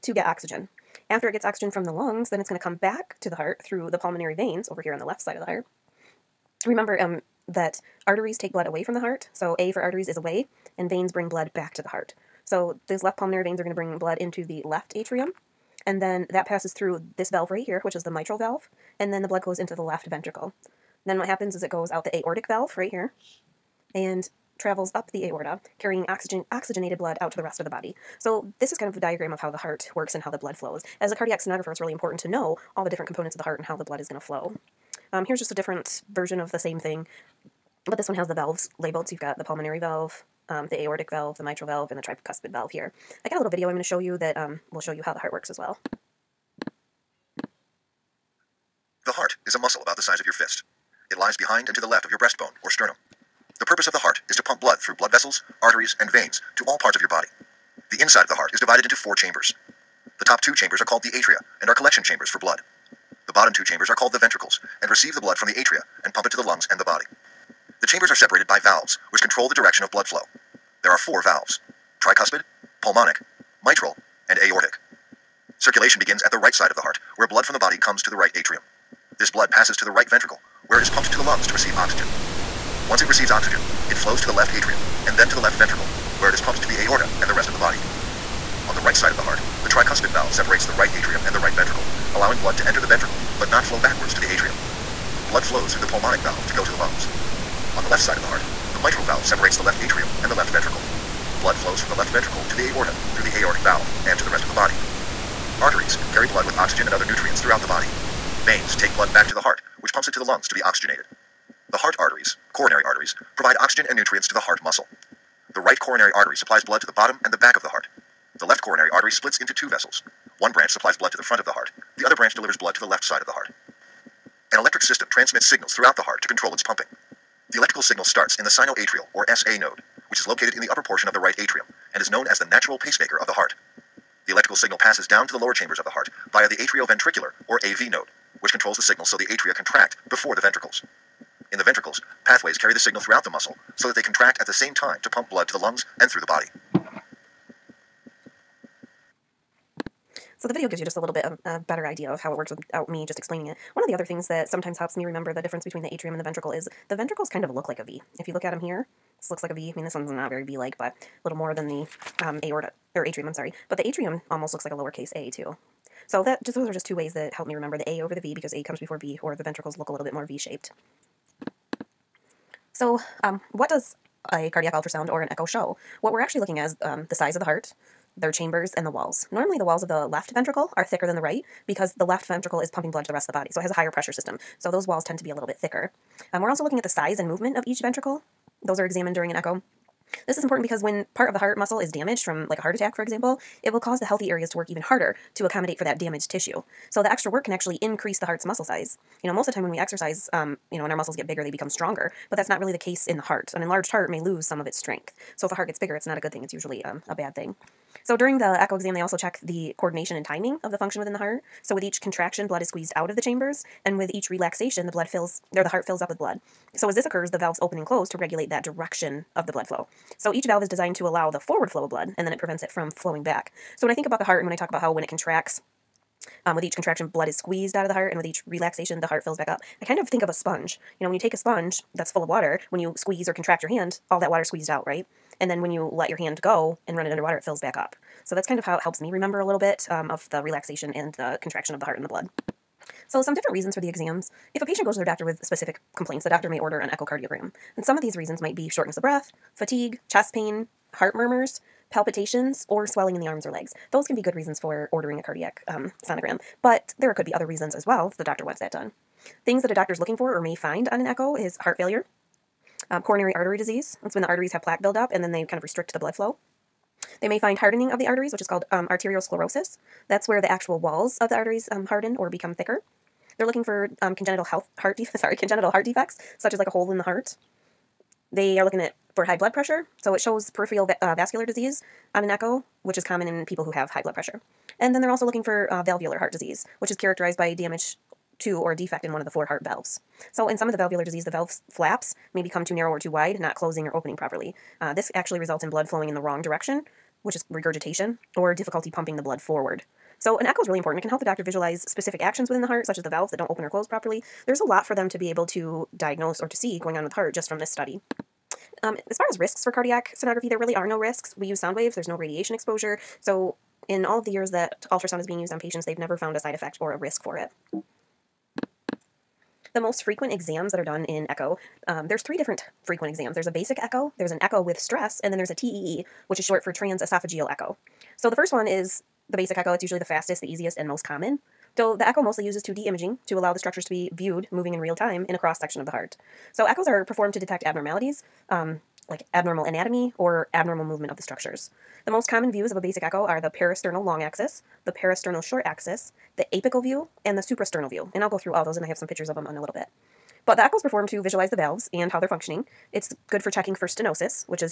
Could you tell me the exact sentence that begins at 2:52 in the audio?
So um, what does a cardiac ultrasound or an echo show.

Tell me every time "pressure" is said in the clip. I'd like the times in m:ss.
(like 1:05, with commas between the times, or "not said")
3:03, 4:39, 4:44.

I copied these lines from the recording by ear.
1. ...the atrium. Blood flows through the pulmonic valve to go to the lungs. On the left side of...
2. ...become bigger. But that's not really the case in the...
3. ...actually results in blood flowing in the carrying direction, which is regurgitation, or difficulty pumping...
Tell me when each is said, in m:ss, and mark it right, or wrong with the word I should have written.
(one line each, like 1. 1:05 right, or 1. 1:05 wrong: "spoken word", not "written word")
1. 1:34 right
2. 3:21 wrong: "stronger", not "bigger"
3. 4:55 wrong: "wrong", not "carrying".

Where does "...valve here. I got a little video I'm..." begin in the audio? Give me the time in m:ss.
0:42.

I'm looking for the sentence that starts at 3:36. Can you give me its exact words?
So as this occurs, the valves open and close to regulate that direction of the blood flow.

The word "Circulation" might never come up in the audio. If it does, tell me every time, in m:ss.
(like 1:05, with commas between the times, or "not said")
1:15.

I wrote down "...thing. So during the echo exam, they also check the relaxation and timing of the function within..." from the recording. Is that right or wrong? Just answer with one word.
wrong.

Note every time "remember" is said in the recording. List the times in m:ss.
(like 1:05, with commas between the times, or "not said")
0:06, 2:35, 2:47, 3:59.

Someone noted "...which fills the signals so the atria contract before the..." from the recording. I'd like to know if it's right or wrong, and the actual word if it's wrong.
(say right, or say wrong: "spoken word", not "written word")
wrong: "controls", not "fills".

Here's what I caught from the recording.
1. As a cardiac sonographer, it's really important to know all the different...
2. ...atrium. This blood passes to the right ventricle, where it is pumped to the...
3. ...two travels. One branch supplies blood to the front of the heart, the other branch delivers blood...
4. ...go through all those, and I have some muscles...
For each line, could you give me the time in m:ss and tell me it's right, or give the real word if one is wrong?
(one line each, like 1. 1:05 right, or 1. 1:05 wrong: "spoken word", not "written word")
1. 0:31 right
2. 1:18 right
3. 1:59 wrong: "vessels", not "travels"
4. 5:48 wrong: "pictures", not "muscles".